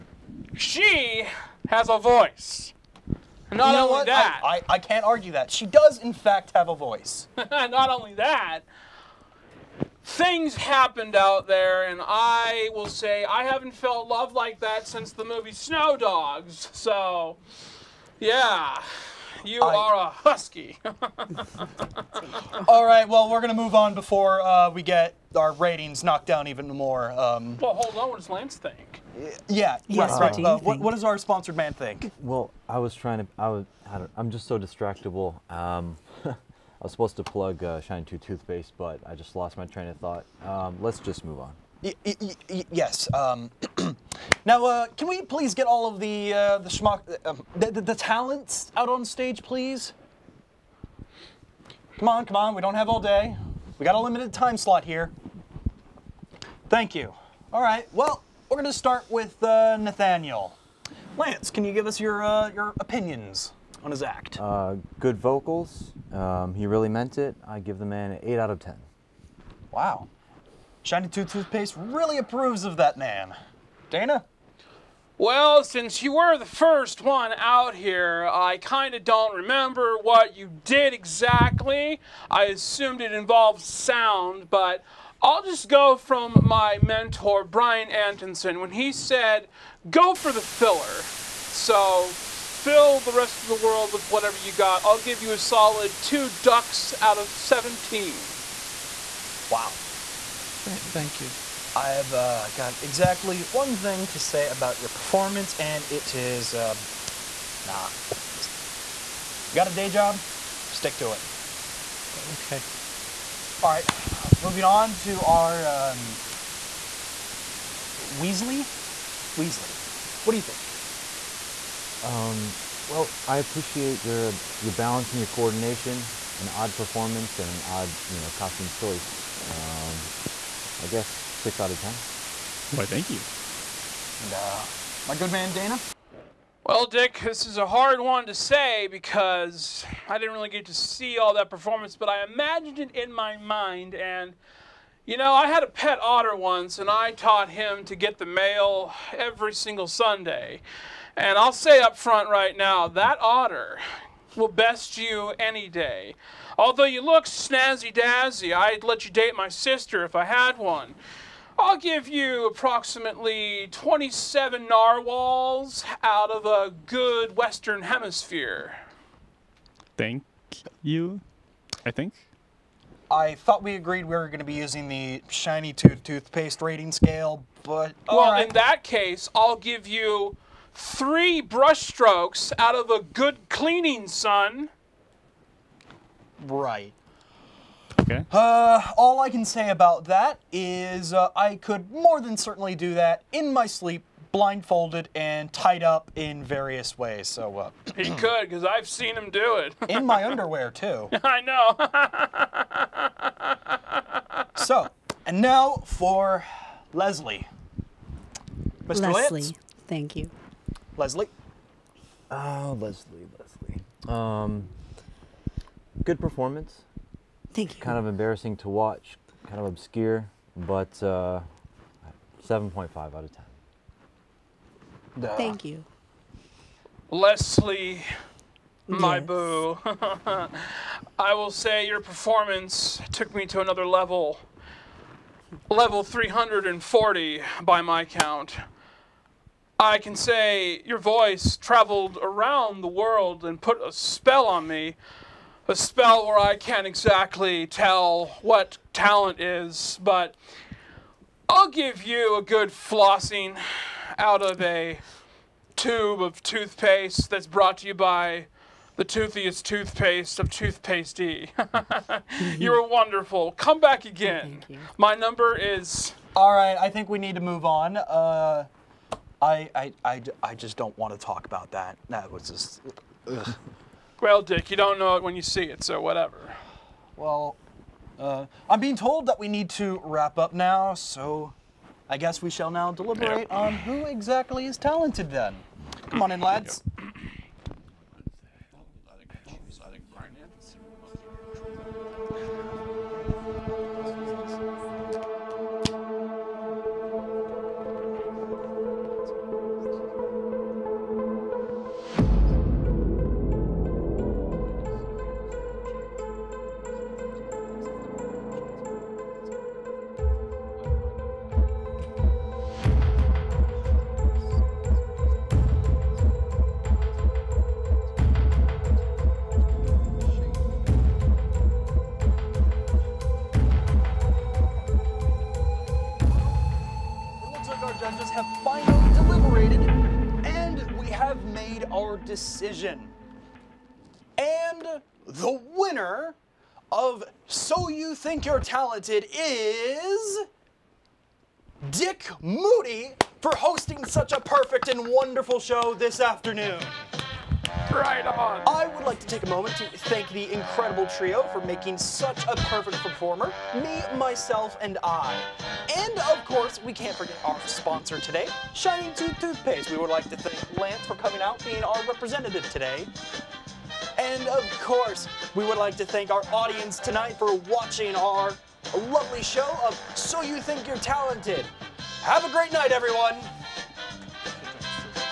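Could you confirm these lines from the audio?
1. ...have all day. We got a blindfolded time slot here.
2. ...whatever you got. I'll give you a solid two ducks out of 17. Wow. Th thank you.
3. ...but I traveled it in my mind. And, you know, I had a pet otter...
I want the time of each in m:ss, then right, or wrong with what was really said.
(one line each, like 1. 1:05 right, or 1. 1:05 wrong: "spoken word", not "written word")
1. 0:52 wrong: "limited", not "blindfolded"
2. 1:34 right
3. 2:21 wrong: "imagined", not "traveled".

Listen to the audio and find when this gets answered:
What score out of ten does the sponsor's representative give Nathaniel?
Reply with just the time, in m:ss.
1:08.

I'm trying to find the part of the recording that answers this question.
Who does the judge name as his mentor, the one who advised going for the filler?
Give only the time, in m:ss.
1:27.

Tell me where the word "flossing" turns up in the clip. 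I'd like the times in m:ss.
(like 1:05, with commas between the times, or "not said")
4:12.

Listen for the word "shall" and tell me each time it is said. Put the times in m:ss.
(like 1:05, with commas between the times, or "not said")
4:42.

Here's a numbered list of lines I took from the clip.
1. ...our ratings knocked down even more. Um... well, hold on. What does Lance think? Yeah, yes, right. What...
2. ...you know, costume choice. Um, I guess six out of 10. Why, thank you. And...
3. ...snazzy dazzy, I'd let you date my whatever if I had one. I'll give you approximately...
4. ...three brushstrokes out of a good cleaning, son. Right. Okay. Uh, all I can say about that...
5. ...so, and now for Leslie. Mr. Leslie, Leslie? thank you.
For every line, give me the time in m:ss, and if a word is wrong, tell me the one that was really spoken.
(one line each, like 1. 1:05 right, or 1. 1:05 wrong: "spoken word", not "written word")
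1. 0:25 right
2. 2:08 right
3. 2:37 wrong: "sister", not "whatever"
4. 3:00 right
5. 3:24 wrong: "Litz", not "Leslie".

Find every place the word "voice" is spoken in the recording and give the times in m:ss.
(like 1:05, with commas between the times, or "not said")
0:01, 0:06, 4:00.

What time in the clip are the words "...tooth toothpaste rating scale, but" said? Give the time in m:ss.
2:55.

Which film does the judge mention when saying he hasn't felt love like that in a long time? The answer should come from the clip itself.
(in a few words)
Snow Dogs.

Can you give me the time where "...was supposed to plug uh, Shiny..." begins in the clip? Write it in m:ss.
0:36.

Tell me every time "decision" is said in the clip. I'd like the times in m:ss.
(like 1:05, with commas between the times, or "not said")
5:32.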